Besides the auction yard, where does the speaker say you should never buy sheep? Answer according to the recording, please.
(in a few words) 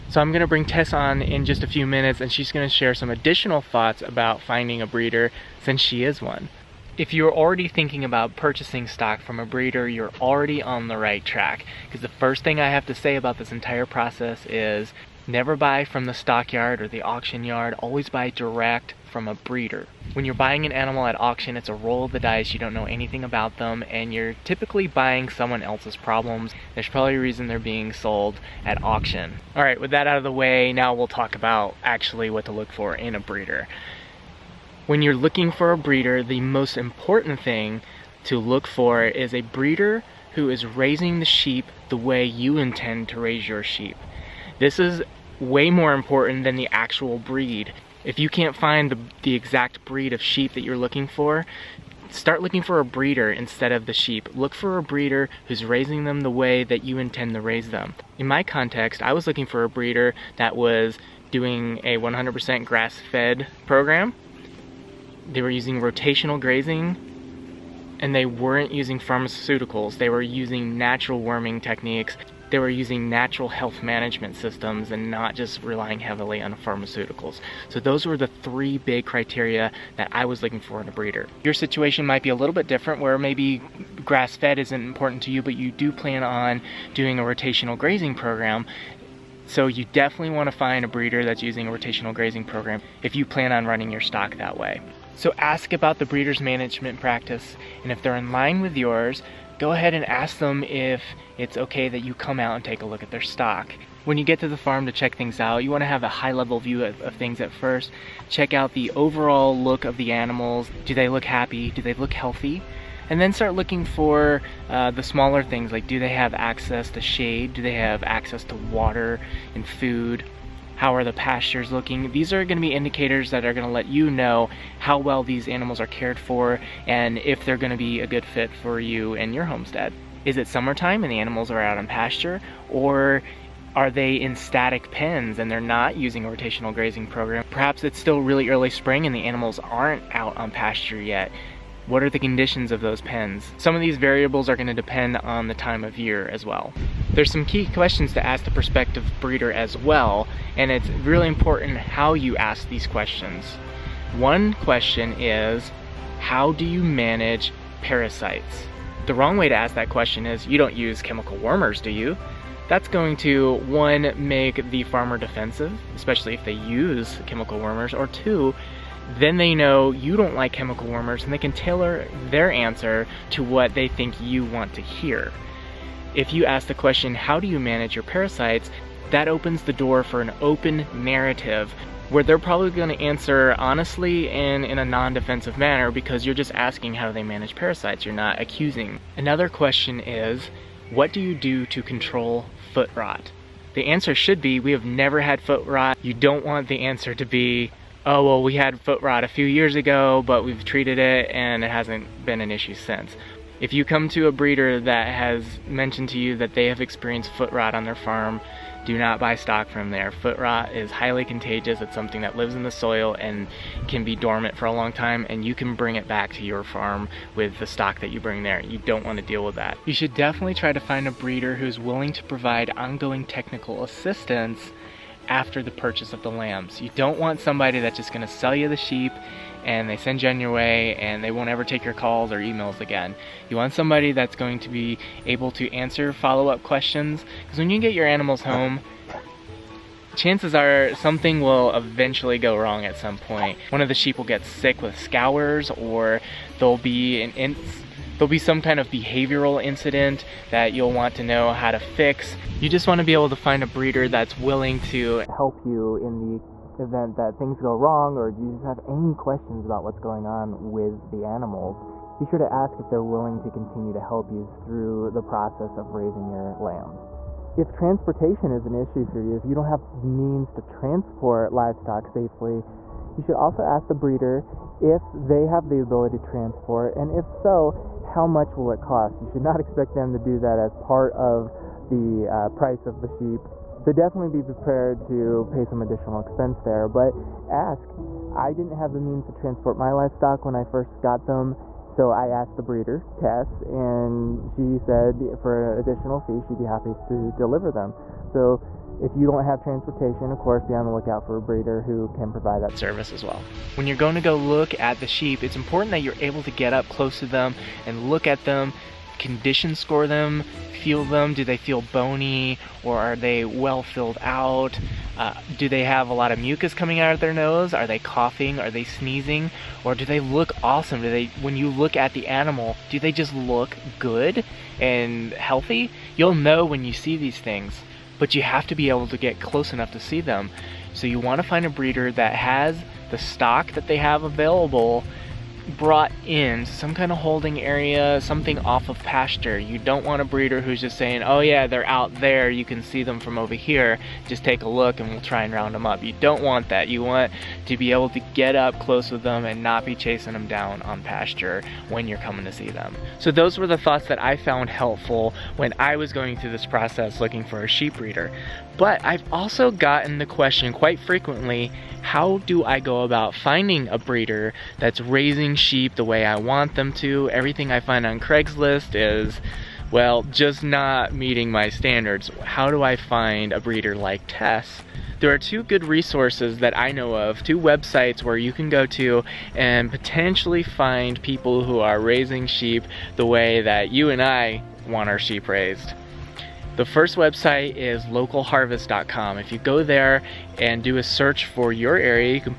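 Stockyard.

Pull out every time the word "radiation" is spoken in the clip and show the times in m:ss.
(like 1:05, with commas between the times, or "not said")
not said.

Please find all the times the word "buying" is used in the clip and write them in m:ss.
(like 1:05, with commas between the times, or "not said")
0:20, 0:24.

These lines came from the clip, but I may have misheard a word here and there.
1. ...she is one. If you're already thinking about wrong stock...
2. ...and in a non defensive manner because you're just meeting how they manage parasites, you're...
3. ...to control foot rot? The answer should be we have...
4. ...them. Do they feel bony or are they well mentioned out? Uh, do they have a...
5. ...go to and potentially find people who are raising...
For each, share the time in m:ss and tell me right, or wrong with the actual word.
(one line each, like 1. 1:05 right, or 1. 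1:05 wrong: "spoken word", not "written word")
1. 0:05 wrong: "purchasing", not "wrong"
2. 3:04 wrong: "asking", not "meeting"
3. 3:11 right
4. 5:11 wrong: "filled", not "mentioned"
5. 6:18 right.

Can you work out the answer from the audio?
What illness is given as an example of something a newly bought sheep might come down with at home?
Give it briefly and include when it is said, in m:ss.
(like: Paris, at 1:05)
Scours, at 4:04.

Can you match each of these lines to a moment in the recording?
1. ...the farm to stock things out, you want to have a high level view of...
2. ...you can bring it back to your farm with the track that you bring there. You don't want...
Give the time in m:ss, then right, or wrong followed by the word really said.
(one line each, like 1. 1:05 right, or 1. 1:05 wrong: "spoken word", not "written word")
1. 1:44 wrong: "check", not "stock"
2. 3:35 wrong: "stock", not "track".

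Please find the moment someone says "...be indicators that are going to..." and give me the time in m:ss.
2:02.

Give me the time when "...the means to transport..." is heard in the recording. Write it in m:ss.
4:48.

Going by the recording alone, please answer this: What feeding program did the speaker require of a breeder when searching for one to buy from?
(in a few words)
100% grass-fed.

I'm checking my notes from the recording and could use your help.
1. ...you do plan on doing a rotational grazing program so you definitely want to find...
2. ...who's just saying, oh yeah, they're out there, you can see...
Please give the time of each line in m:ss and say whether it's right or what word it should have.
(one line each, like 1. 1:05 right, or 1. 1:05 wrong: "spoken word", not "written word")
1. 1:25 right
2. 5:40 right.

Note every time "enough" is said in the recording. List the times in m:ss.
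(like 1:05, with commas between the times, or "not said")
5:29.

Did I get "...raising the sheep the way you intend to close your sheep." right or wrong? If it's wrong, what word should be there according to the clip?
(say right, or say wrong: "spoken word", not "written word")
wrong: "raise", not "close".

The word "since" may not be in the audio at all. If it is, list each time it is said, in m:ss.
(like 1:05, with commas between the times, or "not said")
0:05, 3:22.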